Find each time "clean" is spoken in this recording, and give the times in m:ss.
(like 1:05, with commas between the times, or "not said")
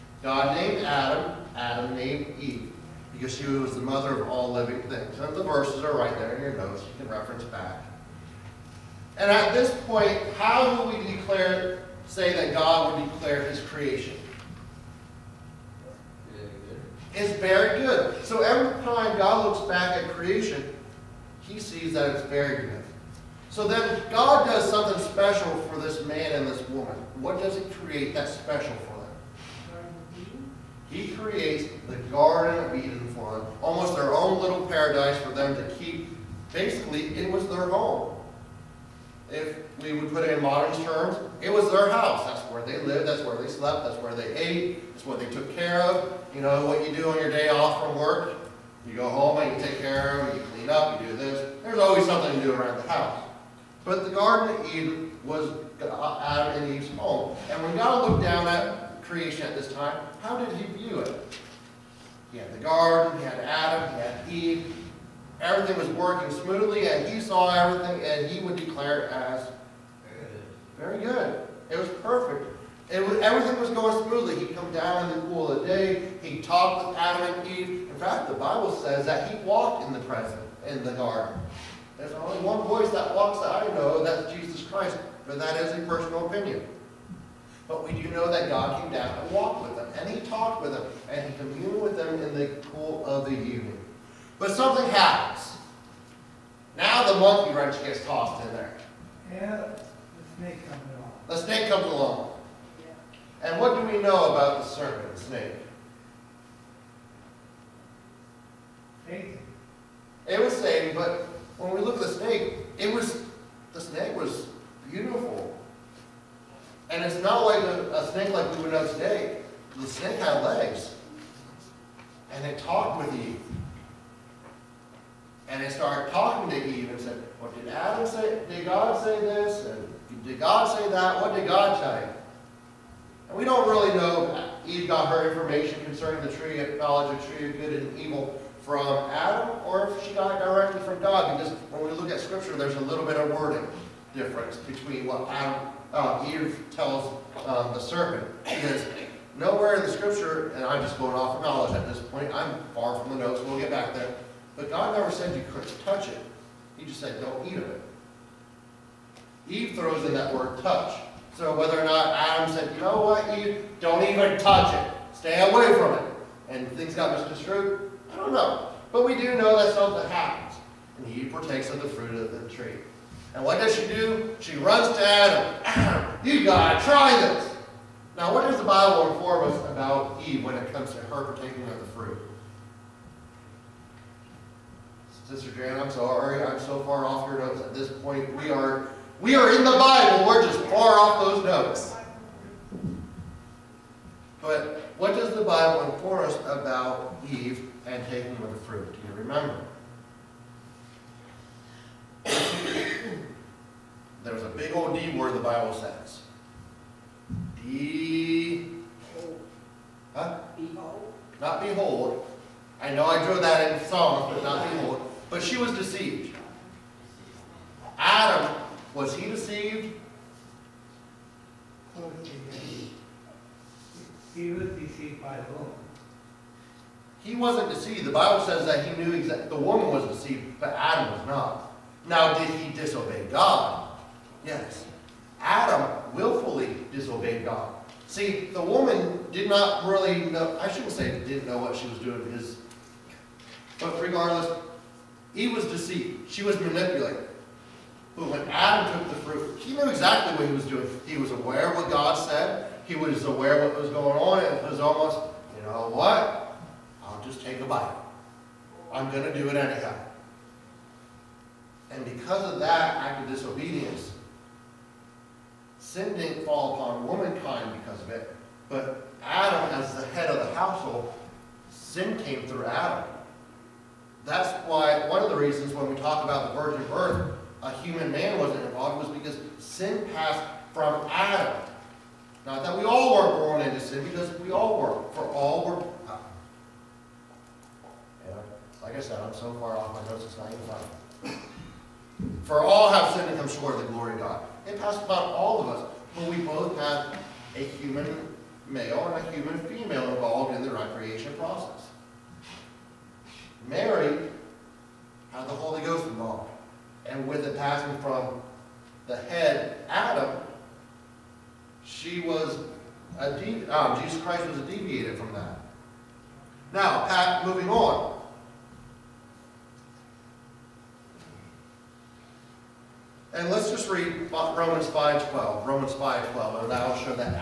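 0:50.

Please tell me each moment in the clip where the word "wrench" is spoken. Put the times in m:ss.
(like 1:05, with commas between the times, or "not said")
1:37.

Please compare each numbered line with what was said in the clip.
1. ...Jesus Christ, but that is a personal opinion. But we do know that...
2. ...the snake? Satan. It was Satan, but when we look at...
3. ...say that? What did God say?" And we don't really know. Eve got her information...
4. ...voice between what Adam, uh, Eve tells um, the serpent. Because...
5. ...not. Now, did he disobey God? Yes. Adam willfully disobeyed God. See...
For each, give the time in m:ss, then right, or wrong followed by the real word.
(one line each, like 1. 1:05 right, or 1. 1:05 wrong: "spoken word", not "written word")
1. 1:24 right
2. 1:45 right
3. 2:10 right
4. 2:24 wrong: "difference", not "voice"
5. 3:51 right.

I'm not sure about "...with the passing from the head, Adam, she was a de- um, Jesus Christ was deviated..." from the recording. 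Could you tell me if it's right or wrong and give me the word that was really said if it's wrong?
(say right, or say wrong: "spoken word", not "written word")
right.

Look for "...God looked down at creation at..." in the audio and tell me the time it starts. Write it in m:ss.
0:57.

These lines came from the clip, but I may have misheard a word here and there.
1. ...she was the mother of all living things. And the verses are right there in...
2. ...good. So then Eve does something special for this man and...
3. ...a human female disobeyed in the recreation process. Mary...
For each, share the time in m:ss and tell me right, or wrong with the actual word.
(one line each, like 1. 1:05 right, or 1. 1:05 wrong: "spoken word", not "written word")
1. 0:03 right
2. 0:22 wrong: "God", not "Eve"
3. 4:59 wrong: "involved", not "disobeyed".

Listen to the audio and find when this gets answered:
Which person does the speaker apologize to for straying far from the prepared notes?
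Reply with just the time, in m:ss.
3:05.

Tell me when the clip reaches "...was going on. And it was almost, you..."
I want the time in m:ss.
4:13.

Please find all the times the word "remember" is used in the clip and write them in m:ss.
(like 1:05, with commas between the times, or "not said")
3:19.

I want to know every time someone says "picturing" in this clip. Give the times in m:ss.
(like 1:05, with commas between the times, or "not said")
not said.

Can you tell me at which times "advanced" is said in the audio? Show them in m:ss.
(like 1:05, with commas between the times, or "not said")
not said.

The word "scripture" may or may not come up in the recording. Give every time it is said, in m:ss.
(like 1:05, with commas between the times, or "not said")
2:22, 2:29.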